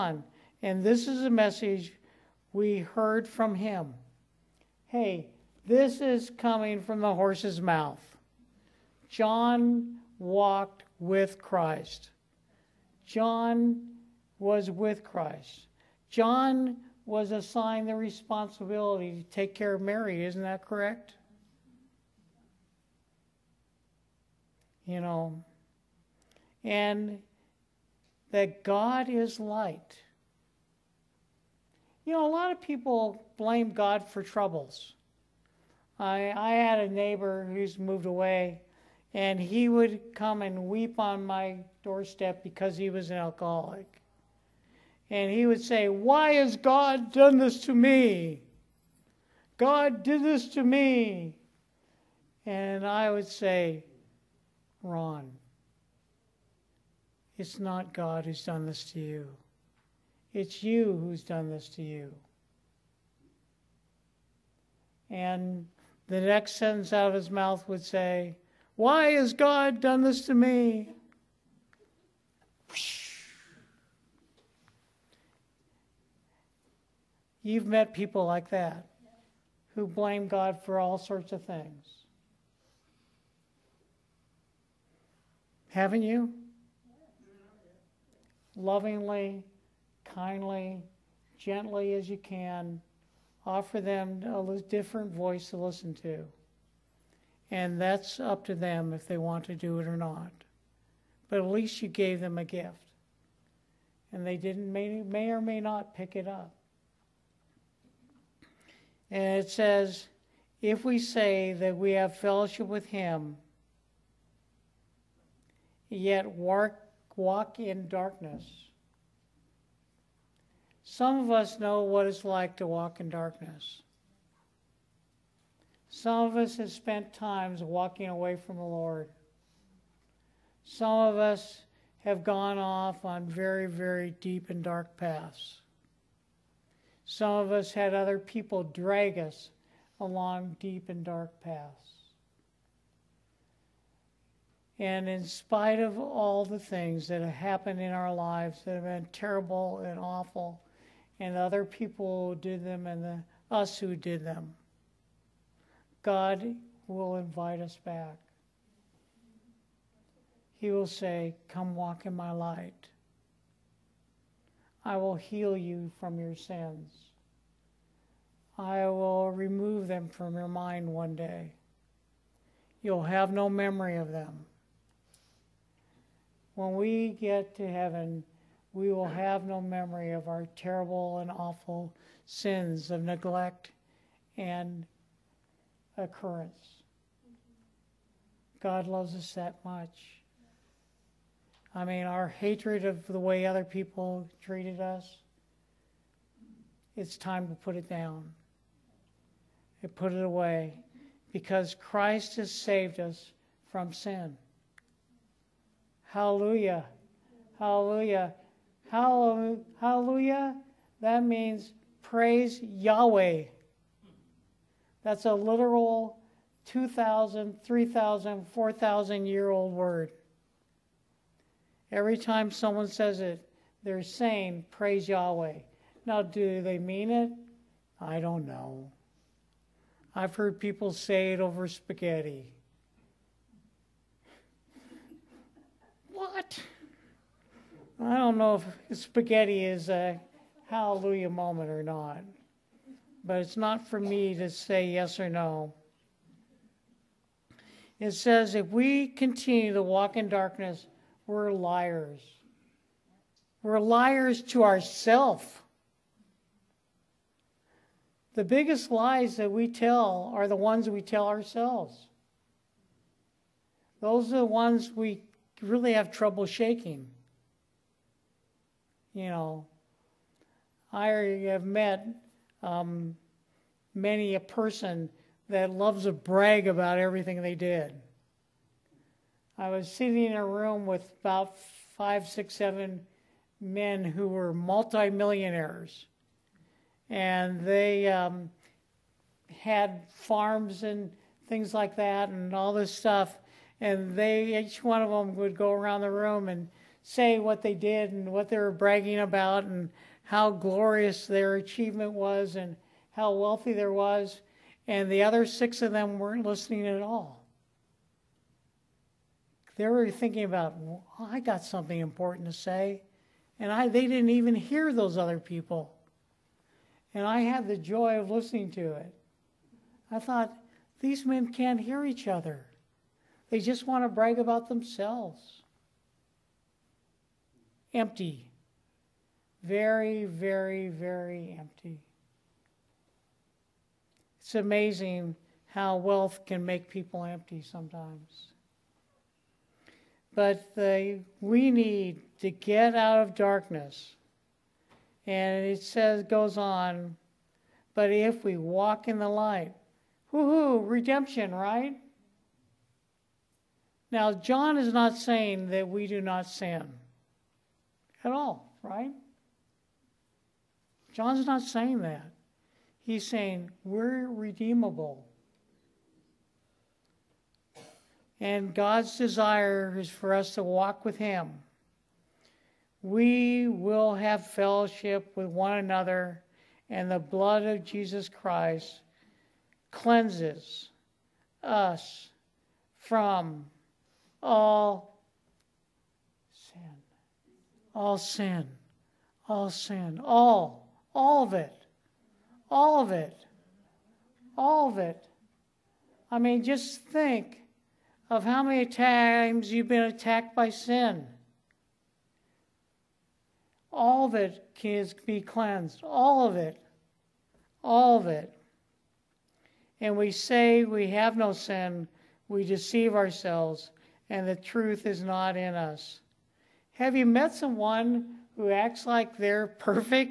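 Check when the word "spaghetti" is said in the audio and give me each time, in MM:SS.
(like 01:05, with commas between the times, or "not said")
03:51, 03:58.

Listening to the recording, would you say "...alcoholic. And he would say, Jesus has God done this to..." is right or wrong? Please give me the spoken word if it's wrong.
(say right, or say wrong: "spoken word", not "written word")
wrong: "Why", not "Jesus".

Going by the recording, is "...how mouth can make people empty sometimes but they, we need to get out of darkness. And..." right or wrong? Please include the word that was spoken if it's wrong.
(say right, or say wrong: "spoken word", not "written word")
wrong: "wealth", not "mouth".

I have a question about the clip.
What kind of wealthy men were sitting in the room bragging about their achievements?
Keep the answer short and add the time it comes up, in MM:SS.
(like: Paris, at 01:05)
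Multimillionaires, at 04:44.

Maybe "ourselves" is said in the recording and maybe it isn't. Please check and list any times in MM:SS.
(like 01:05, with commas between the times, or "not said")
04:14, 04:21, 06:53.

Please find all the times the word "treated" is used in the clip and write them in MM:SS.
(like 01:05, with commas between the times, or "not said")
03:14.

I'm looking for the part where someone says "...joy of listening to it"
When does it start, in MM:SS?
05:17.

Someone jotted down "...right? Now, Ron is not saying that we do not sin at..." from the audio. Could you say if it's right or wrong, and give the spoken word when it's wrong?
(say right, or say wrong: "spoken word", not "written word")
wrong: "John", not "Ron".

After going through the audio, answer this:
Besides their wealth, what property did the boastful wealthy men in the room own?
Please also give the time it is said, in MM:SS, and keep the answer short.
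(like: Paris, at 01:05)
Farms, at 04:50.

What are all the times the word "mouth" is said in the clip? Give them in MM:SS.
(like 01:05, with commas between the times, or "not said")
00:07, 01:07.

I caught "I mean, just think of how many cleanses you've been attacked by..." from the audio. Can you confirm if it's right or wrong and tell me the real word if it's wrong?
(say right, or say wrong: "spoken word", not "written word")
wrong: "times", not "cleanses".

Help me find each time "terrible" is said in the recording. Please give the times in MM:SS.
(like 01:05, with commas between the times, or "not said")
02:29, 03:00.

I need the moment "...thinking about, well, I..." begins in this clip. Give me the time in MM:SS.
05:10.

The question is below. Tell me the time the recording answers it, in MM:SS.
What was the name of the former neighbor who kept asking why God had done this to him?
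00:54.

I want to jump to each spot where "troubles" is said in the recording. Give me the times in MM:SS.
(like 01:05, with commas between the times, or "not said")
00:34, 04:26.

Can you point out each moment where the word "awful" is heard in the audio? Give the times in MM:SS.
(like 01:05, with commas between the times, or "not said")
02:29, 03:01.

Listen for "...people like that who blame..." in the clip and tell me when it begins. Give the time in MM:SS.
01:17.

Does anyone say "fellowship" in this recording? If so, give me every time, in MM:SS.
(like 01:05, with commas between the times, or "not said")
01:52, 06:14.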